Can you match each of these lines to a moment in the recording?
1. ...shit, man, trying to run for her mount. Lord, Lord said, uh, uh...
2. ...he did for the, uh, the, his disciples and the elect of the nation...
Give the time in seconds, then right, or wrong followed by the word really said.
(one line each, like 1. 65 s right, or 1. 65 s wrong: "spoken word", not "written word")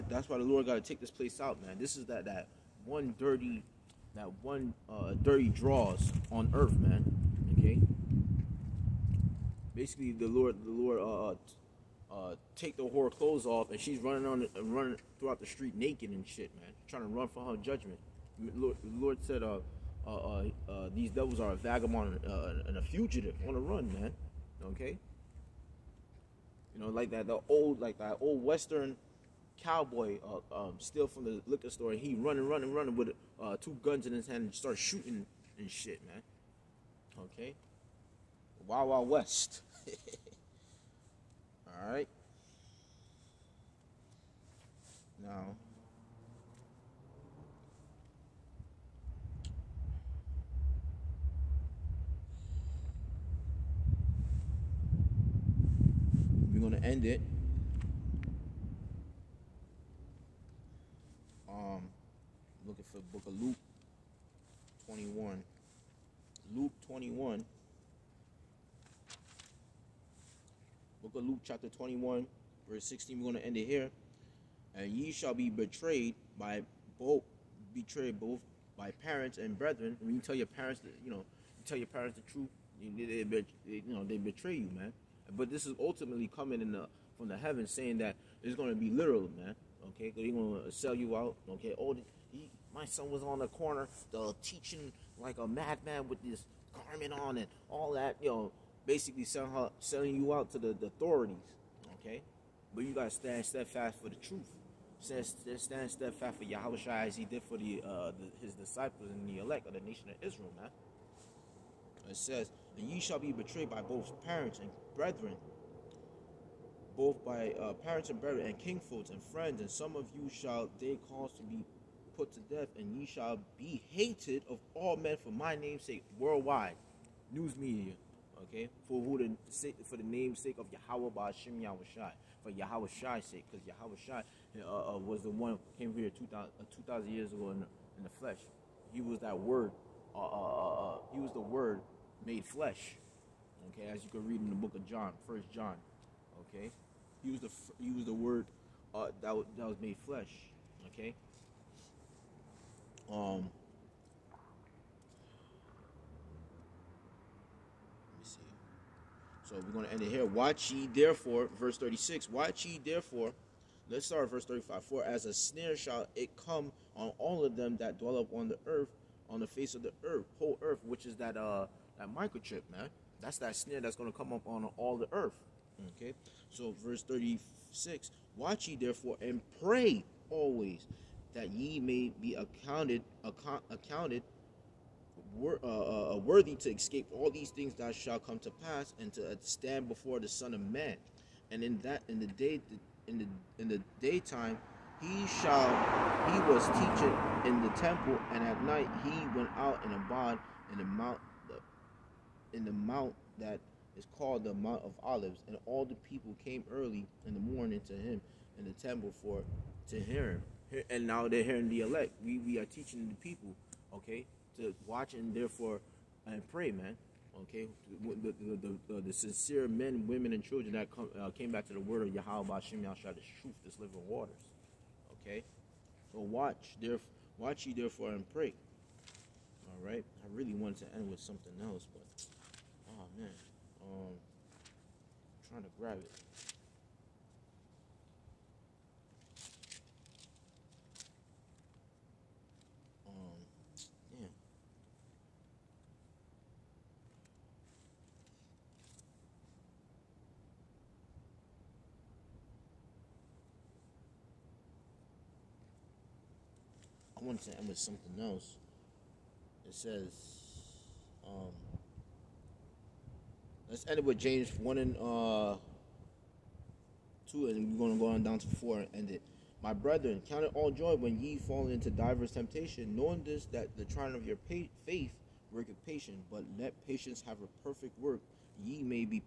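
1. 16 s wrong: "judgment", not "mount"
2. 107 s right.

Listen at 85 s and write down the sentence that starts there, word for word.
But this is ultimately coming in the from the heavens, saying that it's going to be literal, man.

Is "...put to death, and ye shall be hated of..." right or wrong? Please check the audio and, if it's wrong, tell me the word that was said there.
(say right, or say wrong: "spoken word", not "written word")
right.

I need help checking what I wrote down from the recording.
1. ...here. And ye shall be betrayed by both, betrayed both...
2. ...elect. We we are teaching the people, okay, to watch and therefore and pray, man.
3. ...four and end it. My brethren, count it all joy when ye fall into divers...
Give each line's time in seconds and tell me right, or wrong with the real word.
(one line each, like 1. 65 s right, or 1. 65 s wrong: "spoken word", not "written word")
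1. 73 s right
2. 211 s right
3. 268 s right.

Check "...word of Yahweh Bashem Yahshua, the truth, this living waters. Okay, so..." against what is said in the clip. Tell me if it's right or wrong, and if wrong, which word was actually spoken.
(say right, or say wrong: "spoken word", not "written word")
right.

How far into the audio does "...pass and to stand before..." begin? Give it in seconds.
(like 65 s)
188 s.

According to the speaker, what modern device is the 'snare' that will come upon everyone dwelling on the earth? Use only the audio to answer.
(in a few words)
microchip.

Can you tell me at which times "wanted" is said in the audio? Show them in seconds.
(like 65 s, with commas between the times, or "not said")
230 s, 257 s.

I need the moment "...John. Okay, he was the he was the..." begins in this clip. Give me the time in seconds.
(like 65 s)
145 s.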